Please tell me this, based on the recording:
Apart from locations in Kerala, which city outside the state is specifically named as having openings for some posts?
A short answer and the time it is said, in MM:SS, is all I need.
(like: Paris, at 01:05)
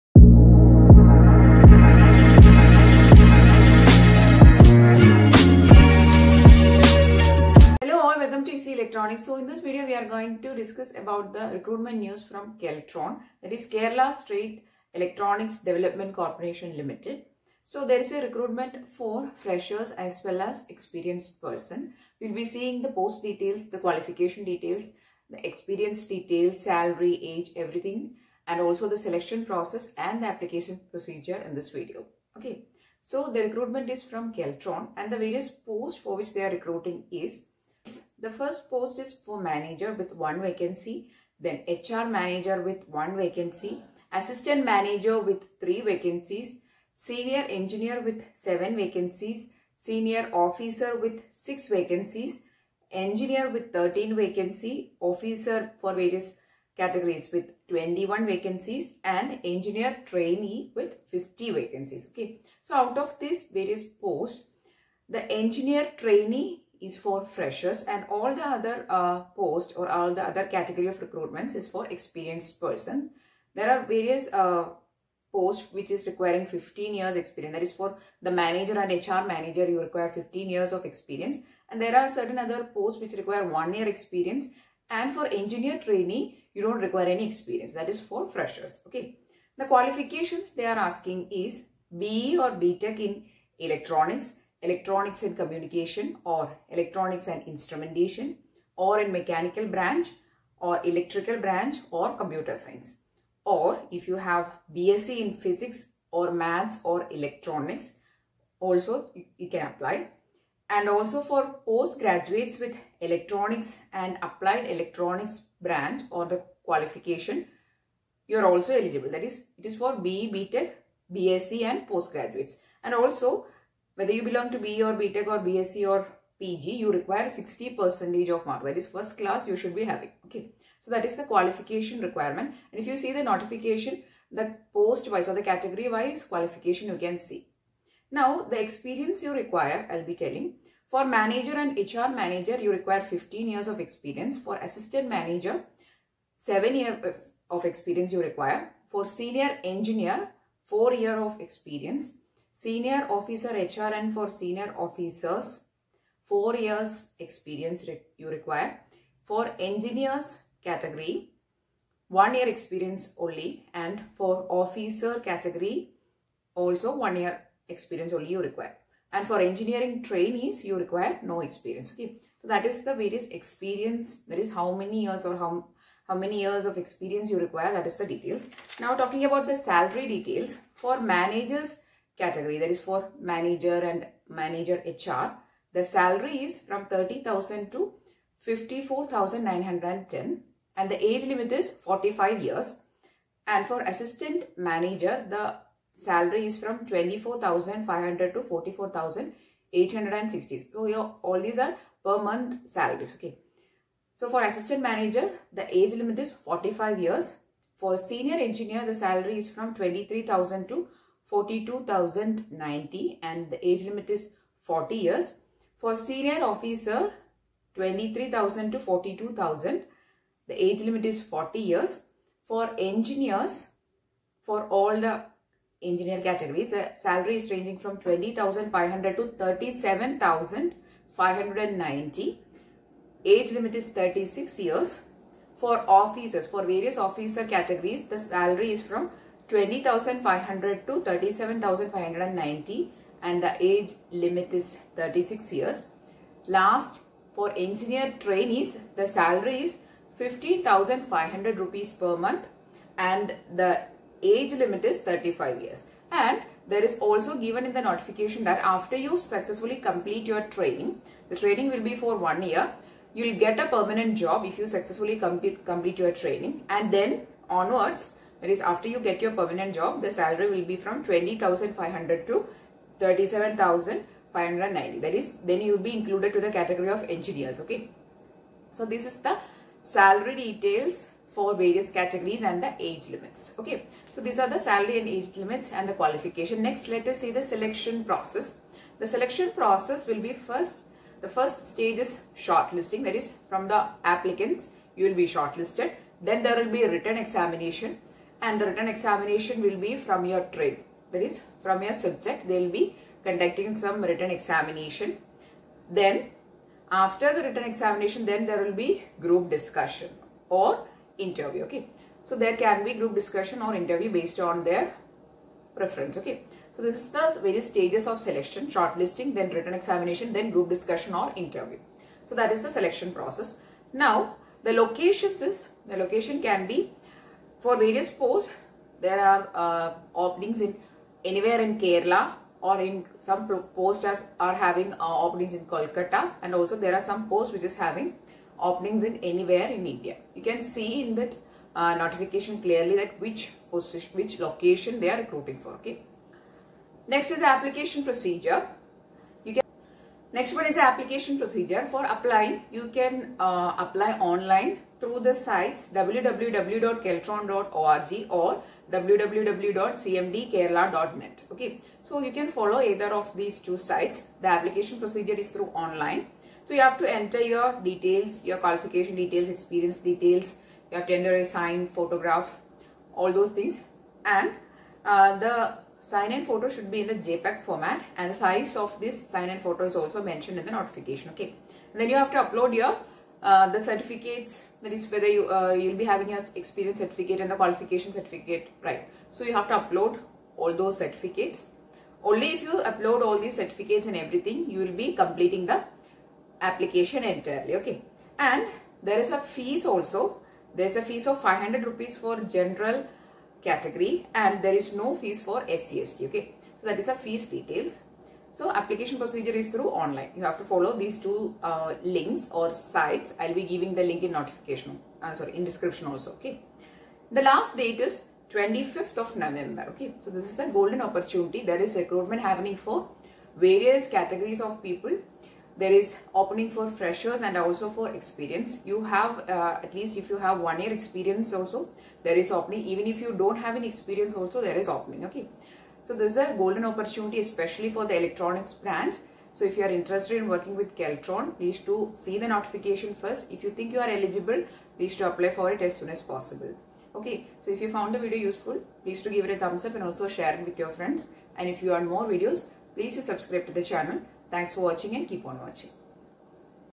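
Kolkata, at 05:35.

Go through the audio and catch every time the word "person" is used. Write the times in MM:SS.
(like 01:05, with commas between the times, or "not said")
00:21, 01:12.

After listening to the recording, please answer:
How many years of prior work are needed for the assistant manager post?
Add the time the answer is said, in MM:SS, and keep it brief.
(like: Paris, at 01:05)
7 years, at 02:26.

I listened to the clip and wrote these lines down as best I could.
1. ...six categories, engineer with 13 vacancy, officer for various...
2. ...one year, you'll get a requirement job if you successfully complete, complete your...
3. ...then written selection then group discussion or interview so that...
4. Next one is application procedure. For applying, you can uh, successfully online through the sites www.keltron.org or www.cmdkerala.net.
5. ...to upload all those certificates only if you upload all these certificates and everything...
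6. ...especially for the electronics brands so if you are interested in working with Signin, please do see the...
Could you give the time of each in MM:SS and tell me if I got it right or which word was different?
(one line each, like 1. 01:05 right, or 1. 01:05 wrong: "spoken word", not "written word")
1. 00:51 wrong: "vacancies", not "categories"
2. 04:22 wrong: "permanent", not "requirement"
3. 05:19 wrong: "examination", not "selection"
4. 05:50 wrong: "apply", not "successfully"
5. 06:29 right
6. 07:17 wrong: "Keltron", not "Signin".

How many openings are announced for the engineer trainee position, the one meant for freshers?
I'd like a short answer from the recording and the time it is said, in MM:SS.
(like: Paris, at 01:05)
50, at 01:01.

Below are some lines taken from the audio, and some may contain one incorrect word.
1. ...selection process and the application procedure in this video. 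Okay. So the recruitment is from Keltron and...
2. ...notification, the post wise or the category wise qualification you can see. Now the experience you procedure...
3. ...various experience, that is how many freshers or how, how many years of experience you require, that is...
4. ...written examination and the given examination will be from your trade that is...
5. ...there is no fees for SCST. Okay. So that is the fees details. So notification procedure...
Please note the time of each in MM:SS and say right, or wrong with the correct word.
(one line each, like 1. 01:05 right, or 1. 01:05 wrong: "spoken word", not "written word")
1. 00:28 right
2. 02:13 wrong: "require", not "procedure"
3. 02:52 wrong: "years", not "freshers"
4. 04:56 wrong: "written", not "given"
5. 06:44 wrong: "application", not "notification".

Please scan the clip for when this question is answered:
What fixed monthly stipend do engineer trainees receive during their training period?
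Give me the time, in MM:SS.
04:10.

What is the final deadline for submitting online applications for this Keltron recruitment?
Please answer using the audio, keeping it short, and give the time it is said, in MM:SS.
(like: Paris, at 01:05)
25 November, at 06:58.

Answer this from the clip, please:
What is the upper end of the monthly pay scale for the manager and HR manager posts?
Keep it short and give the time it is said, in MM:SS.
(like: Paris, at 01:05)
54,910, at 03:08.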